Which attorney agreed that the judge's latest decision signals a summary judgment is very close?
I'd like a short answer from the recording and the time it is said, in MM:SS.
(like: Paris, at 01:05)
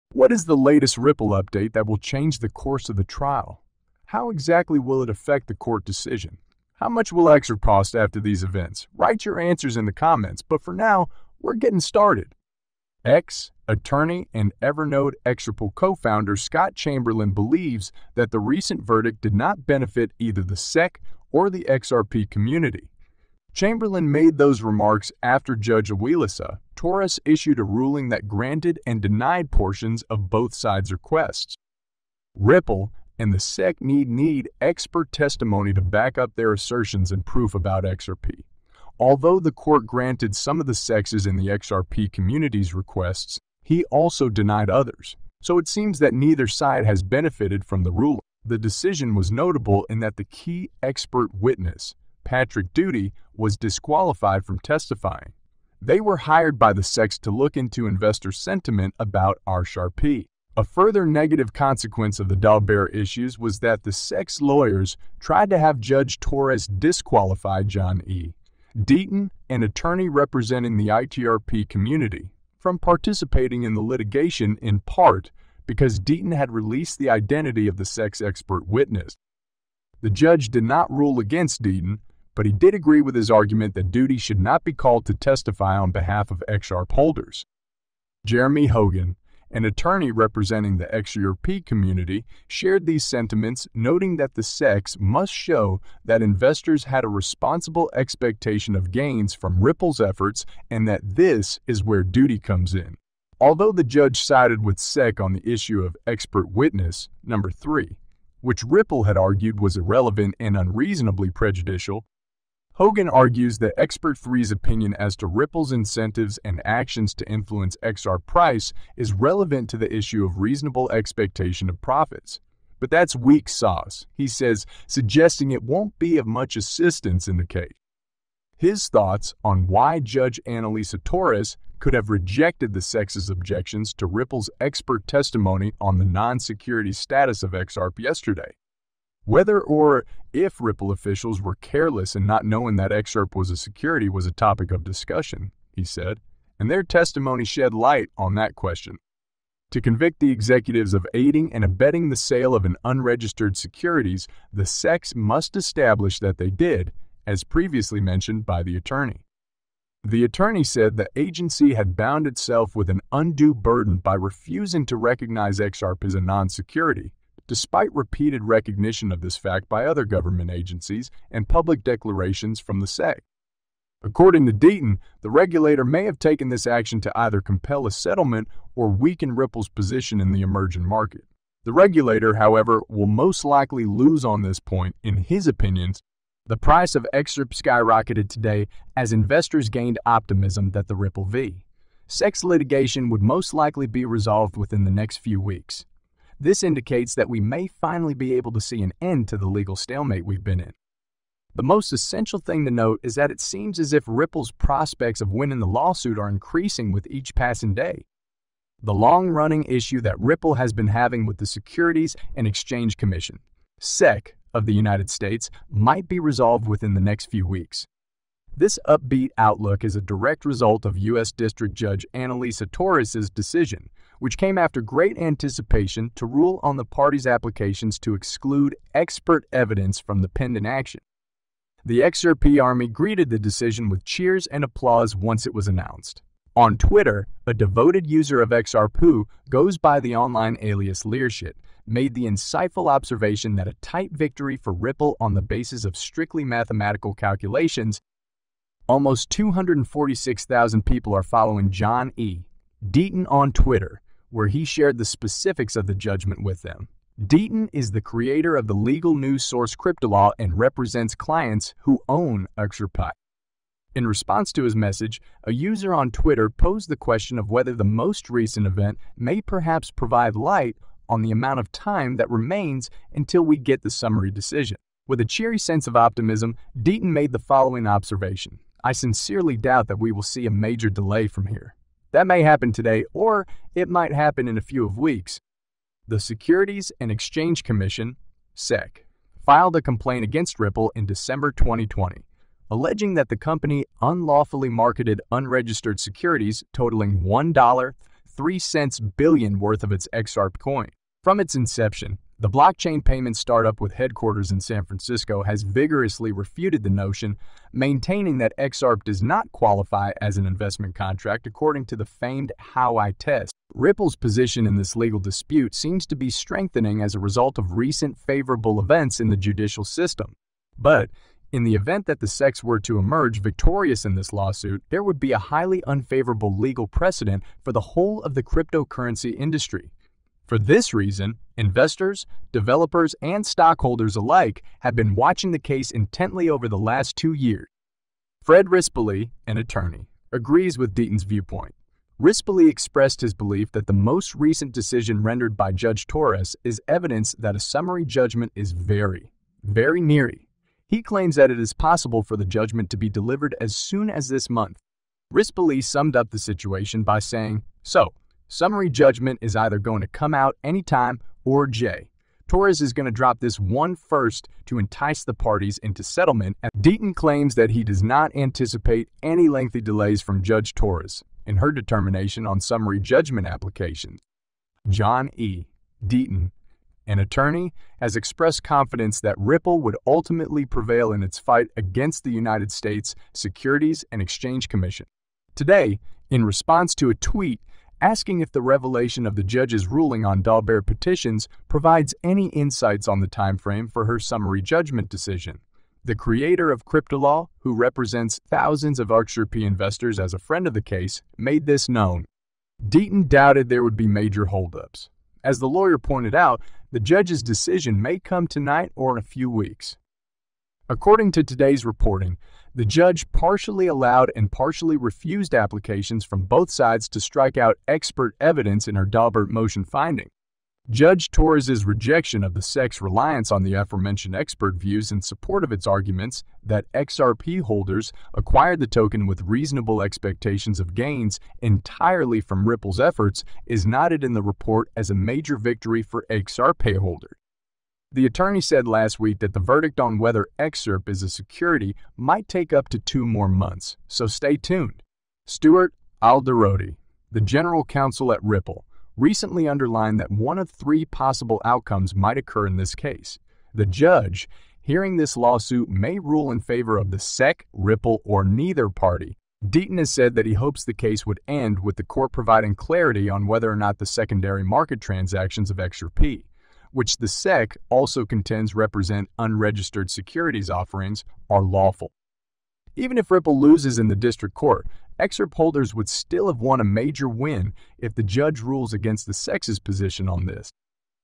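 Fred Rispoli, at 05:38.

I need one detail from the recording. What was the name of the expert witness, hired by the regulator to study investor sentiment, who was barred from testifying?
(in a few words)
Patrick Duty.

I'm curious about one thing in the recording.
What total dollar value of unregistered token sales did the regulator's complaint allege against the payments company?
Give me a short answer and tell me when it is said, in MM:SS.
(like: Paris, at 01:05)
$1.03 billion, at 04:57.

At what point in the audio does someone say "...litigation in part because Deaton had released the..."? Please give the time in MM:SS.
01:13.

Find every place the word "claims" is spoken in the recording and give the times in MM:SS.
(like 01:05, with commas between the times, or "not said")
05:51, 06:07.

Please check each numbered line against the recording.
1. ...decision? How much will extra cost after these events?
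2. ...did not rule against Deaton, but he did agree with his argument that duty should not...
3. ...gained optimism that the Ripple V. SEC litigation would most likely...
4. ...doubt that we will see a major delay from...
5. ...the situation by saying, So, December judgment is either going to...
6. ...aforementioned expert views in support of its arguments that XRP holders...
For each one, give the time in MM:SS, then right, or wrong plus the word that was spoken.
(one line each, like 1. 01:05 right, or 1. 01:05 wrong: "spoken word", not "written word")
1. 00:05 right
2. 01:20 right
3. 03:09 right
4. 04:39 right
5. 05:56 wrong: "Summary", not "December"
6. 07:03 right.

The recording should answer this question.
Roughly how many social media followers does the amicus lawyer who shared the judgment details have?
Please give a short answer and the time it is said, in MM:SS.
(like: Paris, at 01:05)
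246,000, at 04:09.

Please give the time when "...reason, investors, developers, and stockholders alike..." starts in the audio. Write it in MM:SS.
05:30.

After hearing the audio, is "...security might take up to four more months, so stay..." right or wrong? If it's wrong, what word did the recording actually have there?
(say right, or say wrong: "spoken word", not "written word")
wrong: "two", not "four".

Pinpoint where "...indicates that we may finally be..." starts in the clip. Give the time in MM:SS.
03:16.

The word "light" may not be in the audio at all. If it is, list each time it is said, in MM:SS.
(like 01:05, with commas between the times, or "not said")
02:27, 04:30.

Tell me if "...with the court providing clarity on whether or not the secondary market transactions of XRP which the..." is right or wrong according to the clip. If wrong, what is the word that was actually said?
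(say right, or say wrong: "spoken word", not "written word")
right.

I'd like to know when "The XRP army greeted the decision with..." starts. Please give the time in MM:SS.
03:51.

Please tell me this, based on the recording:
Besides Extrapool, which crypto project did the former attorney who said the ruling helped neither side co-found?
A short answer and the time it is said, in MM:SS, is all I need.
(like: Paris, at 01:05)
Evernode, at 00:14.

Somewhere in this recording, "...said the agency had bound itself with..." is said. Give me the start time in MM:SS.
02:40.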